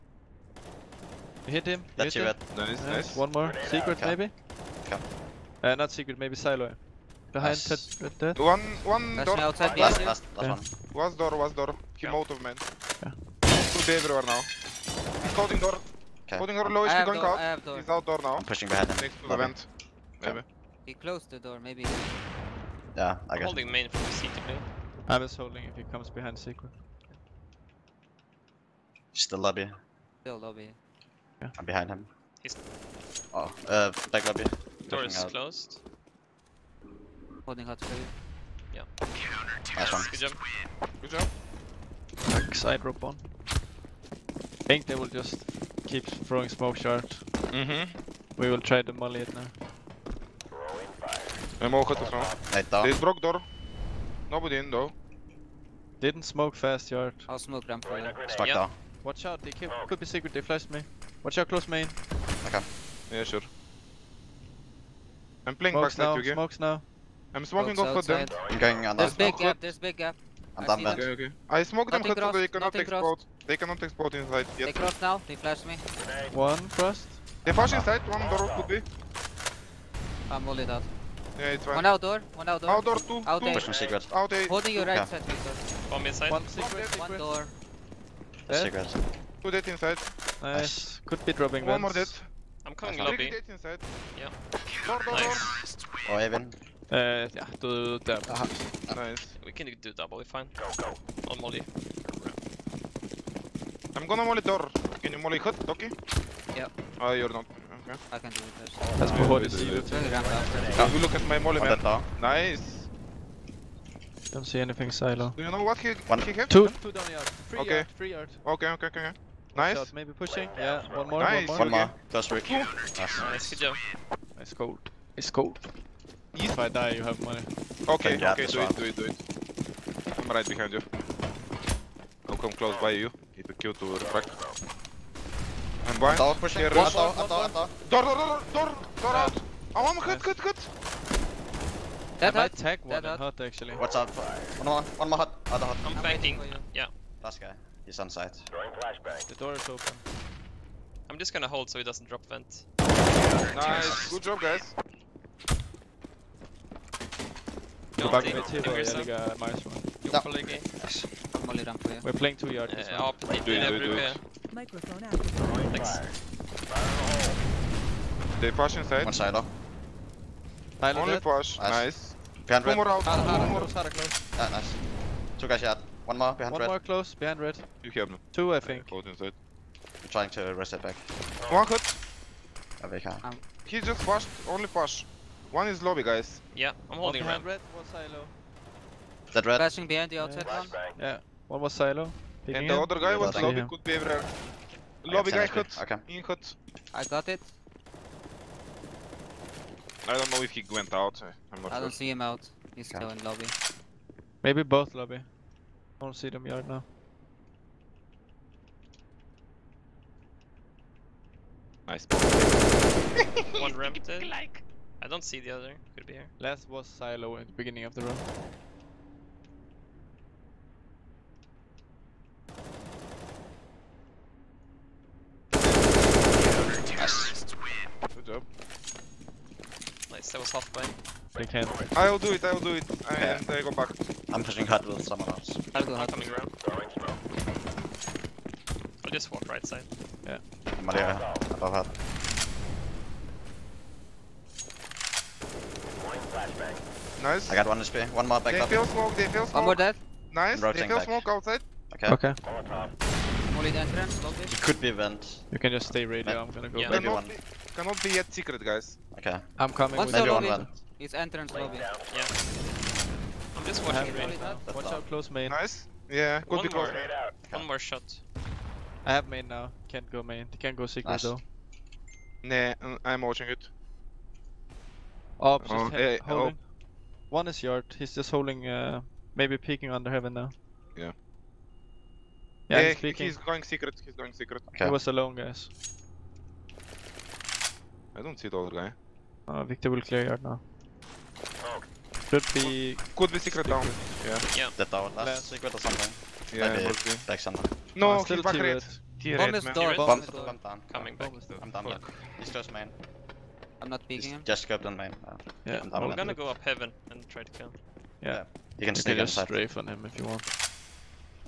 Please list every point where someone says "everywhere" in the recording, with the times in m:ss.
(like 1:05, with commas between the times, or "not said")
0:13, 3:13.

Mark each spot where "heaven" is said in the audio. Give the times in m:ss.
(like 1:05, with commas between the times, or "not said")
4:40, 5:06.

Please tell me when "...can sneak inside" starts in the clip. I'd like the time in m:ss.
5:08.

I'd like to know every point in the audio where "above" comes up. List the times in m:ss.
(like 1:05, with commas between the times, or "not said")
4:01.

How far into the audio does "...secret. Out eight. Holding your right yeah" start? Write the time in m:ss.
1:23.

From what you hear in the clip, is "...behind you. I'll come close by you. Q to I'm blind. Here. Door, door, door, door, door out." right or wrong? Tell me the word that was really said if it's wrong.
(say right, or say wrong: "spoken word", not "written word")
right.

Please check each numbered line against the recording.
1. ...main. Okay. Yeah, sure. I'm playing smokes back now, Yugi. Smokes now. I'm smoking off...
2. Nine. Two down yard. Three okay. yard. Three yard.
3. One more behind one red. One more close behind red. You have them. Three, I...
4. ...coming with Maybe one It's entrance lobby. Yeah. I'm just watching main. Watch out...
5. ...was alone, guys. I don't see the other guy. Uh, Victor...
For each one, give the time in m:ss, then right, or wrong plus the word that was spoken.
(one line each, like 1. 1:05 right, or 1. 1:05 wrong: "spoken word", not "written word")
1. 1:01 right
2. 1:56 wrong: "Two", not "Nine"
3. 2:56 wrong: "Two", not "Three"
4. 4:19 right
5. 4:44 right.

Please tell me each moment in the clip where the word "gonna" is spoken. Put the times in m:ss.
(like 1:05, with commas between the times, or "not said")
1:44, 2:31, 4:16, 5:06.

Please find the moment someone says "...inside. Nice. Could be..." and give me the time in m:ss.
1:29.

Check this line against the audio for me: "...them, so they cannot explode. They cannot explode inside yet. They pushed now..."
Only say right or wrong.
wrong.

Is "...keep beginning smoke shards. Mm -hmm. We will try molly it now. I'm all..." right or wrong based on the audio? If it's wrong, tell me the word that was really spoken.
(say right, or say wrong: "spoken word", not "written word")
wrong: "throwing", not "beginning".